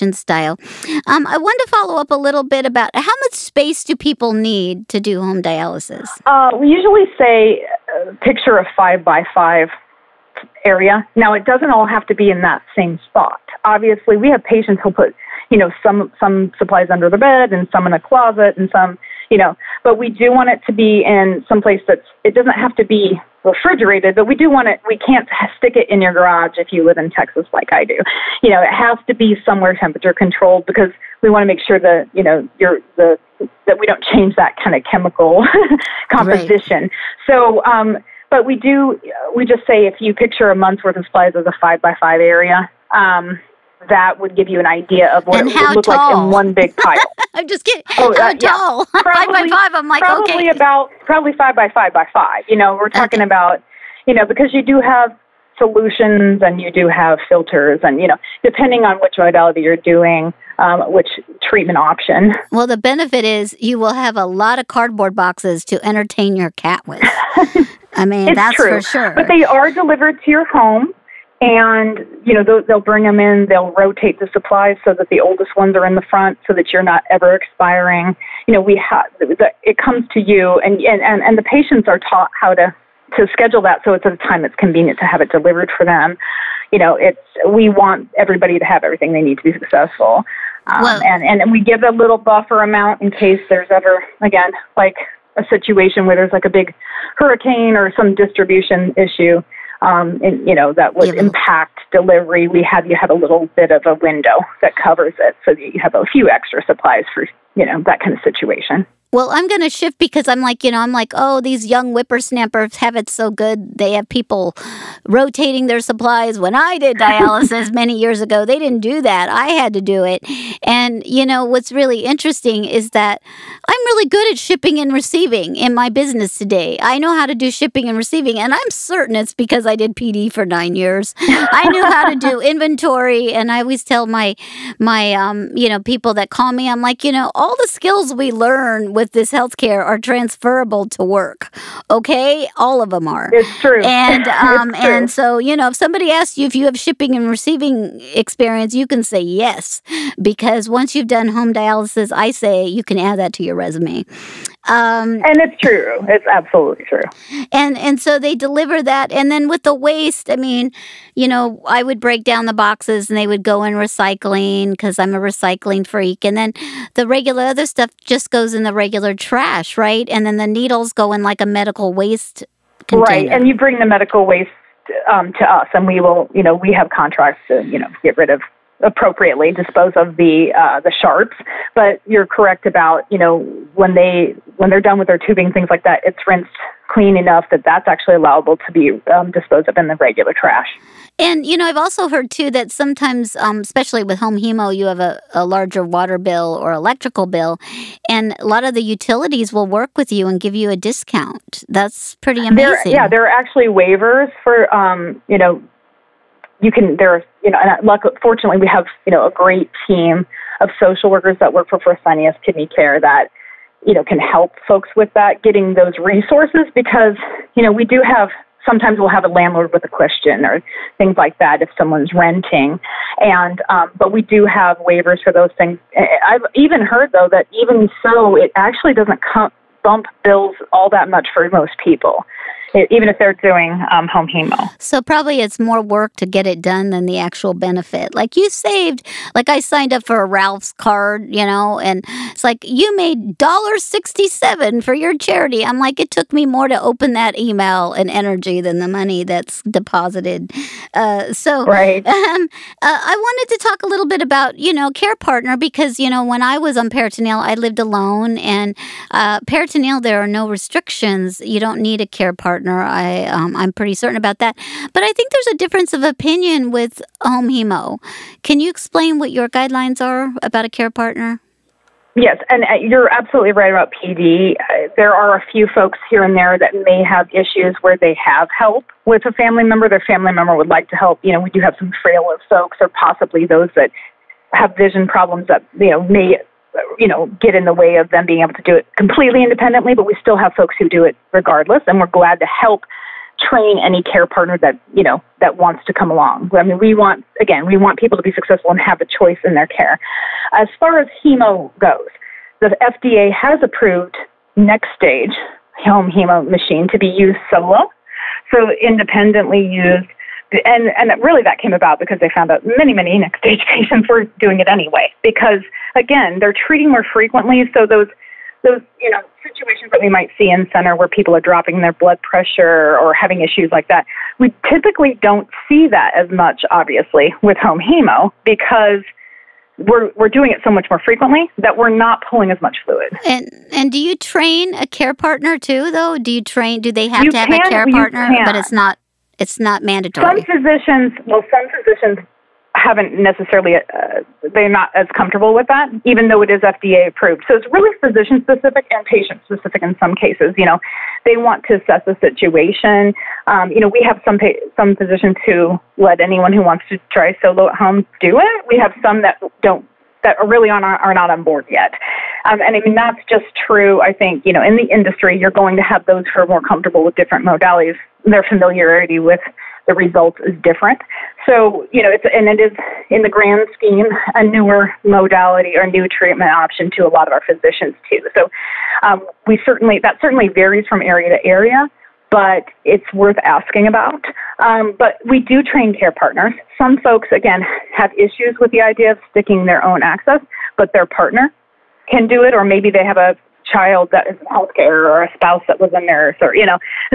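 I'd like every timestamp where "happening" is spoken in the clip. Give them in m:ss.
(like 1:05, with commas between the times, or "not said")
not said.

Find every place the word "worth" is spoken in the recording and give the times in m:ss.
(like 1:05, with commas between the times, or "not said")
0:40, 6:23.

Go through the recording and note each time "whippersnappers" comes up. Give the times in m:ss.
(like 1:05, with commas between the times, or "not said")
1:51.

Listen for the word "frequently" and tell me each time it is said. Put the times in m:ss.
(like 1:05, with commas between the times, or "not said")
5:17, 5:31.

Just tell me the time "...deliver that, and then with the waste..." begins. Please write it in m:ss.
2:38.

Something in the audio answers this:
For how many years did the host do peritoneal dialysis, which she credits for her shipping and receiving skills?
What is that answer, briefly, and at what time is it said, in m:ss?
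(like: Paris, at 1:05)
9, at 2:10.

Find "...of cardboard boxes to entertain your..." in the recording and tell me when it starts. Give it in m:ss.
1:04.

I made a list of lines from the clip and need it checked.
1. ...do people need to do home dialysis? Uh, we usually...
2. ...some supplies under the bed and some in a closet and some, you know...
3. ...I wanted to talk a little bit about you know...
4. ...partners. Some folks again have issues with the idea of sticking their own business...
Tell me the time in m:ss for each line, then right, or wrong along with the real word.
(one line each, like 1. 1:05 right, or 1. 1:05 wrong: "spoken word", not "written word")
1. 0:03 right
2. 0:16 right
3. 4:12 right
4. 6:26 wrong: "access", not "business".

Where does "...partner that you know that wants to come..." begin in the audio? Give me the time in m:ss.
4:54.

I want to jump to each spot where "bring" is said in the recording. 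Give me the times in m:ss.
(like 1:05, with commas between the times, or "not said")
1:12, 2:53.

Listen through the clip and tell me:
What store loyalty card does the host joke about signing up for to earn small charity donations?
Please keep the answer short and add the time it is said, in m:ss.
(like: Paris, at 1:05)
Ralph's, at 4:00.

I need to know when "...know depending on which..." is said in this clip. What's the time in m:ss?
0:58.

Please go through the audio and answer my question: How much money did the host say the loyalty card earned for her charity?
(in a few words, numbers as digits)
$1.67.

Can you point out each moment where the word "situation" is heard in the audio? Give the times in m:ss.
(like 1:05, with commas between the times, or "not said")
1:35, 1:48, 5:19, 5:52.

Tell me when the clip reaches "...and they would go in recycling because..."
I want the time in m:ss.
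2:43.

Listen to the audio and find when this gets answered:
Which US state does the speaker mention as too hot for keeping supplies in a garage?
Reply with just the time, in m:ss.
0:27.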